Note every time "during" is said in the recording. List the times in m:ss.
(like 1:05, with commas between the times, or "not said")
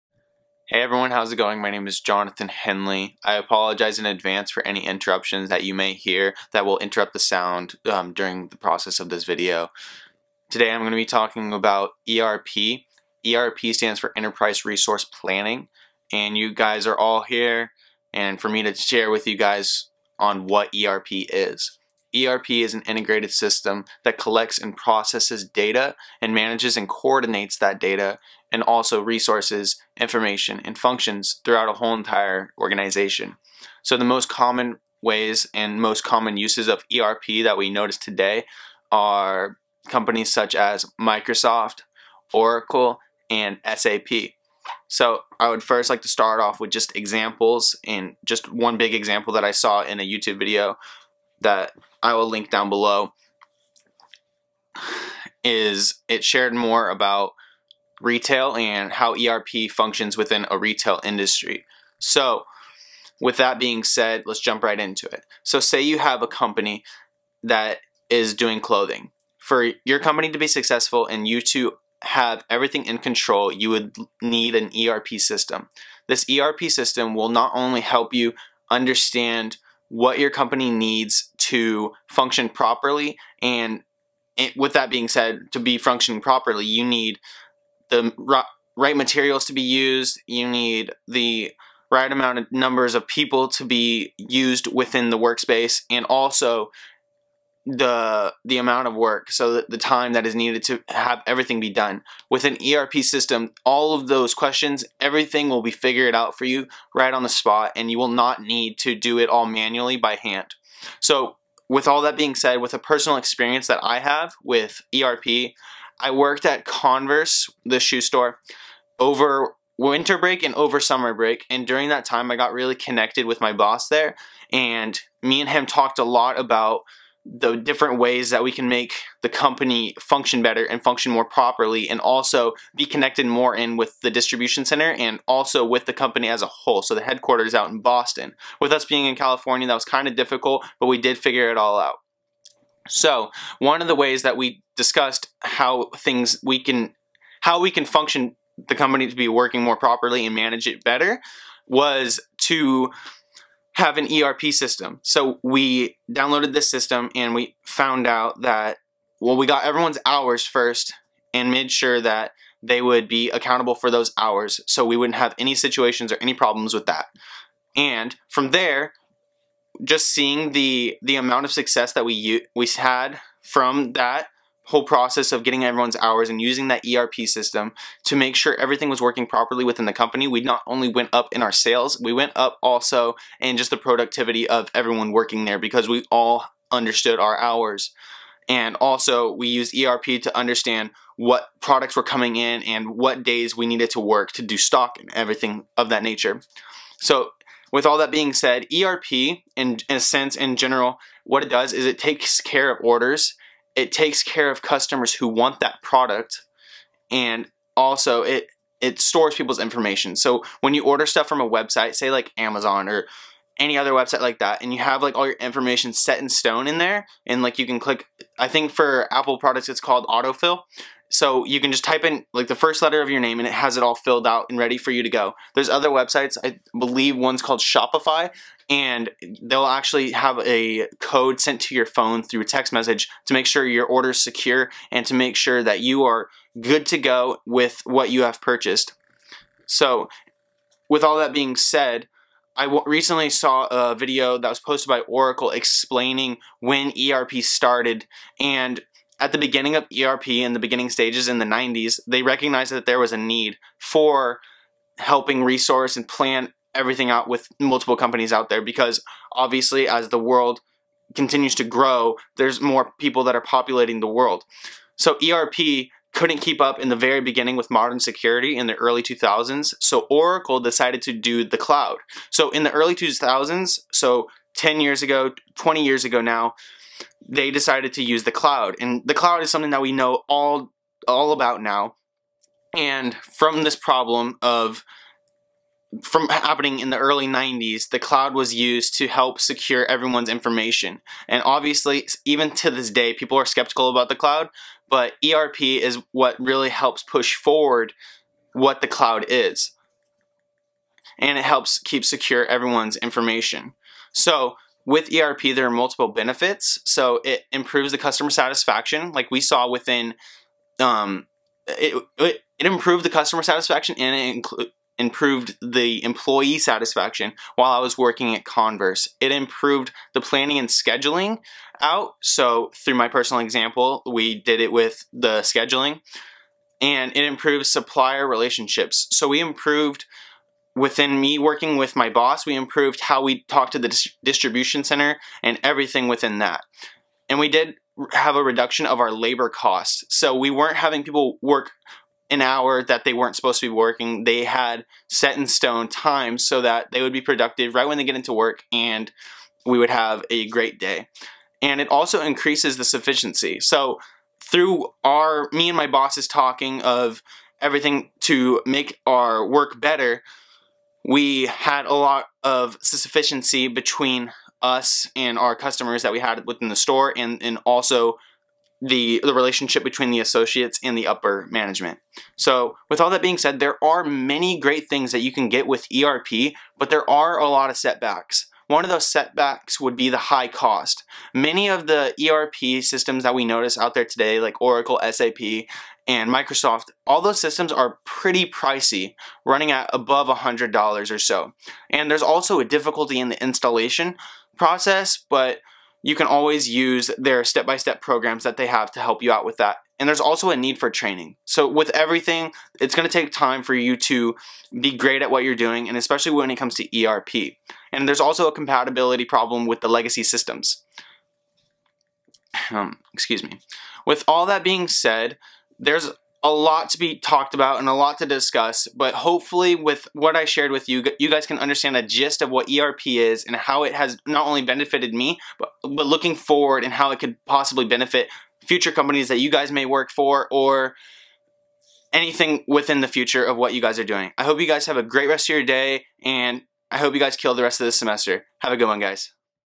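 0:08, 2:01.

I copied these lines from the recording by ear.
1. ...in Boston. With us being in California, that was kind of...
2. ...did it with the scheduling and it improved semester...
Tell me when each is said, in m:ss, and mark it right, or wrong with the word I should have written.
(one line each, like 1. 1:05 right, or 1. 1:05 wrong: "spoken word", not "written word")
1. 2:17 right
2. 5:24 wrong: "supplier", not "semester".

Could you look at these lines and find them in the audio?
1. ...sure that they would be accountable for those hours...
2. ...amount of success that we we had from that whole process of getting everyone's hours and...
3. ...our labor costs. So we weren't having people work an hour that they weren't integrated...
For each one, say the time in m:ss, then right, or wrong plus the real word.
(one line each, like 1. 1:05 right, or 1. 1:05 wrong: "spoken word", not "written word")
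1. 2:41 right
2. 2:51 right
3. 5:38 wrong: "supposed", not "integrated".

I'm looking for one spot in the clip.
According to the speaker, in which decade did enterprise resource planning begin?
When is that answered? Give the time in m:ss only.
4:11.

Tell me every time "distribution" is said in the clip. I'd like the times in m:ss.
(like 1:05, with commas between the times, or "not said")
2:14, 5:34.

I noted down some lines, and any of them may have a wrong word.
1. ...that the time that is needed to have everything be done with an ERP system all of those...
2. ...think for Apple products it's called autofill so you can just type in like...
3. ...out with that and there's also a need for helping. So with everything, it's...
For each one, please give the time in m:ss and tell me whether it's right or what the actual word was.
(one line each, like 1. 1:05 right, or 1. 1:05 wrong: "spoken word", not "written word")
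1. 1:39 right
2. 3:38 right
3. 6:39 wrong: "training", not "helping".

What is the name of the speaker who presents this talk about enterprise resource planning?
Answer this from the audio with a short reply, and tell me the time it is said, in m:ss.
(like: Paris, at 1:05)
Jonathan Henley, at 0:01.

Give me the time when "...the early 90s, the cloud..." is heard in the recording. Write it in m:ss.
4:46.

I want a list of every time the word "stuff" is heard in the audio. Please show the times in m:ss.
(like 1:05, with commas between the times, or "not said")
3:31.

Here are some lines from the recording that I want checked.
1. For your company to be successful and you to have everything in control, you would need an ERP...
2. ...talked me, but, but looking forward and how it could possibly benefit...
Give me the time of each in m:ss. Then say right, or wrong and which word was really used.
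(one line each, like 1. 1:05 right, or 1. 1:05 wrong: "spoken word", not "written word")
1. 1:09 right
2. 7:04 wrong: "benefited", not "talked".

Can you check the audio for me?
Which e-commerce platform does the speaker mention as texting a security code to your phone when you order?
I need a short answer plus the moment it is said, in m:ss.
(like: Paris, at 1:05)
Shopify, at 3:47.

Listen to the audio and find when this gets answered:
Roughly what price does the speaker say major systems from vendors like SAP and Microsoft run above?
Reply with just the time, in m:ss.
6:30.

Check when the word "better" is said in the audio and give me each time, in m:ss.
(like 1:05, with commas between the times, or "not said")
2:10, 2:30, 5:59.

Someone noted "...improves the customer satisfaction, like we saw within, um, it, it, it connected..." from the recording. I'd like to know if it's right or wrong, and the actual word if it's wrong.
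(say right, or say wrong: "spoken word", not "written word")
wrong: "improved", not "connected".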